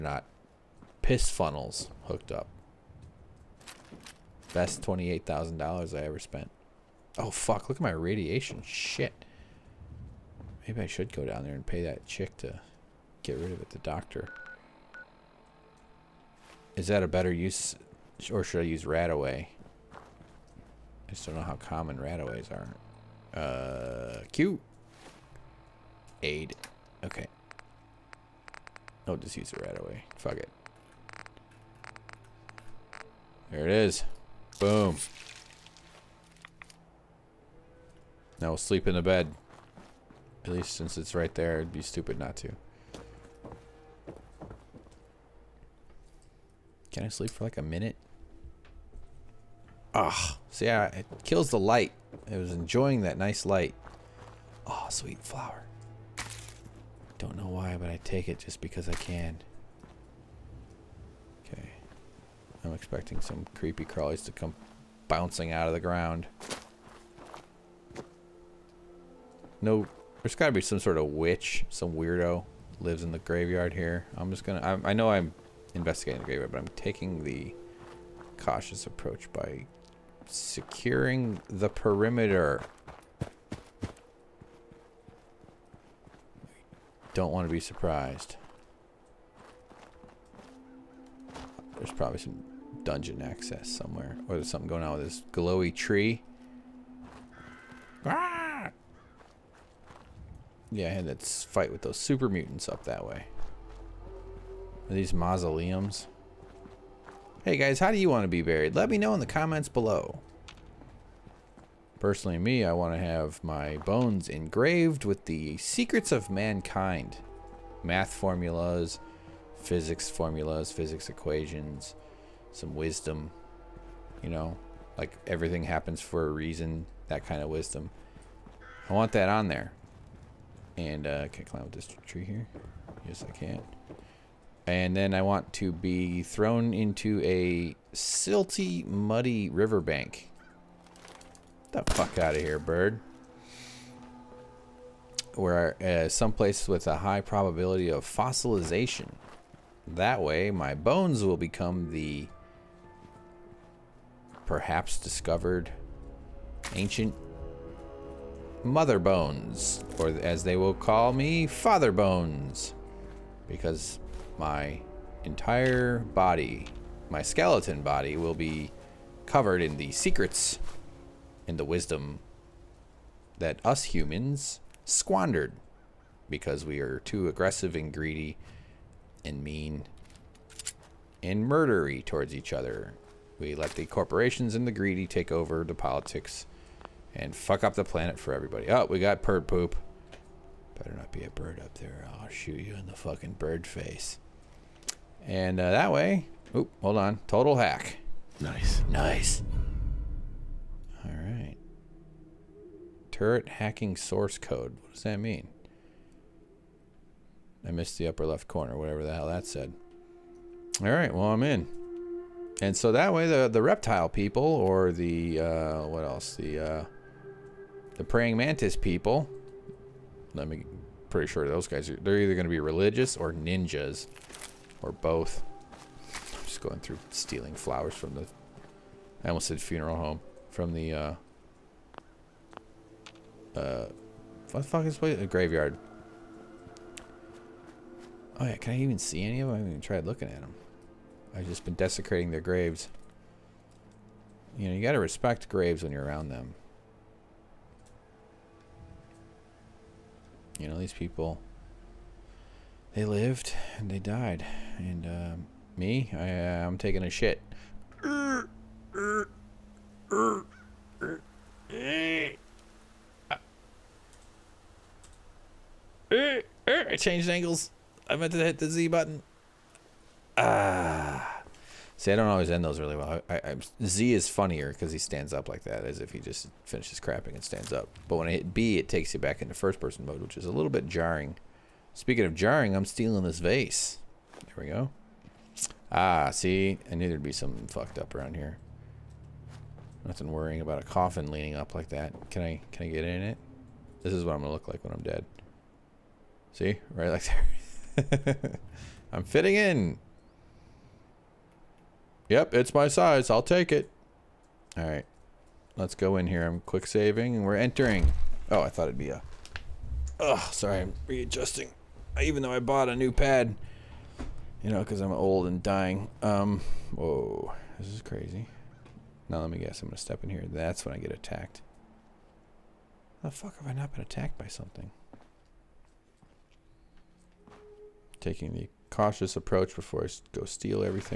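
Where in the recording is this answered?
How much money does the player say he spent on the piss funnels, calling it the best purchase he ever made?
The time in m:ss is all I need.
0:04.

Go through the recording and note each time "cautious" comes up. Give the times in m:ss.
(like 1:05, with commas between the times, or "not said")
1:18, 5:28.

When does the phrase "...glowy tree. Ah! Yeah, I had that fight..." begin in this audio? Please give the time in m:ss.
1:35.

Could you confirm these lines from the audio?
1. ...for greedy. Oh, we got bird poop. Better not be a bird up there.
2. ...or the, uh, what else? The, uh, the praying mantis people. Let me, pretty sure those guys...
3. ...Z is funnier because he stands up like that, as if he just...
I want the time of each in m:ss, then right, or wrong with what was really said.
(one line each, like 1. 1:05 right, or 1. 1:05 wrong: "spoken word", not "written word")
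1. 3:08 wrong: "everybody", not "greedy"
2. 3:34 right
3. 4:33 right.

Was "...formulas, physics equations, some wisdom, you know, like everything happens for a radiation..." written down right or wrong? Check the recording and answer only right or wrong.
wrong.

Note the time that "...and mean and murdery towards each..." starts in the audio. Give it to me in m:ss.
2:59.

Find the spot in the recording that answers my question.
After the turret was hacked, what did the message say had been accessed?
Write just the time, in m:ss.
3:23.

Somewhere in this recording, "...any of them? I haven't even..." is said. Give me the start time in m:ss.
3:59.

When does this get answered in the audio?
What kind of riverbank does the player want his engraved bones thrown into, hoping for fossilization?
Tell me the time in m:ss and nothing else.
2:17.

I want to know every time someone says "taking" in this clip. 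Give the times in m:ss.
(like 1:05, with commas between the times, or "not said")
1:16, 4:16, 5:28.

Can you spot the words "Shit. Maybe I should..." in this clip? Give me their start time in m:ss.
0:08.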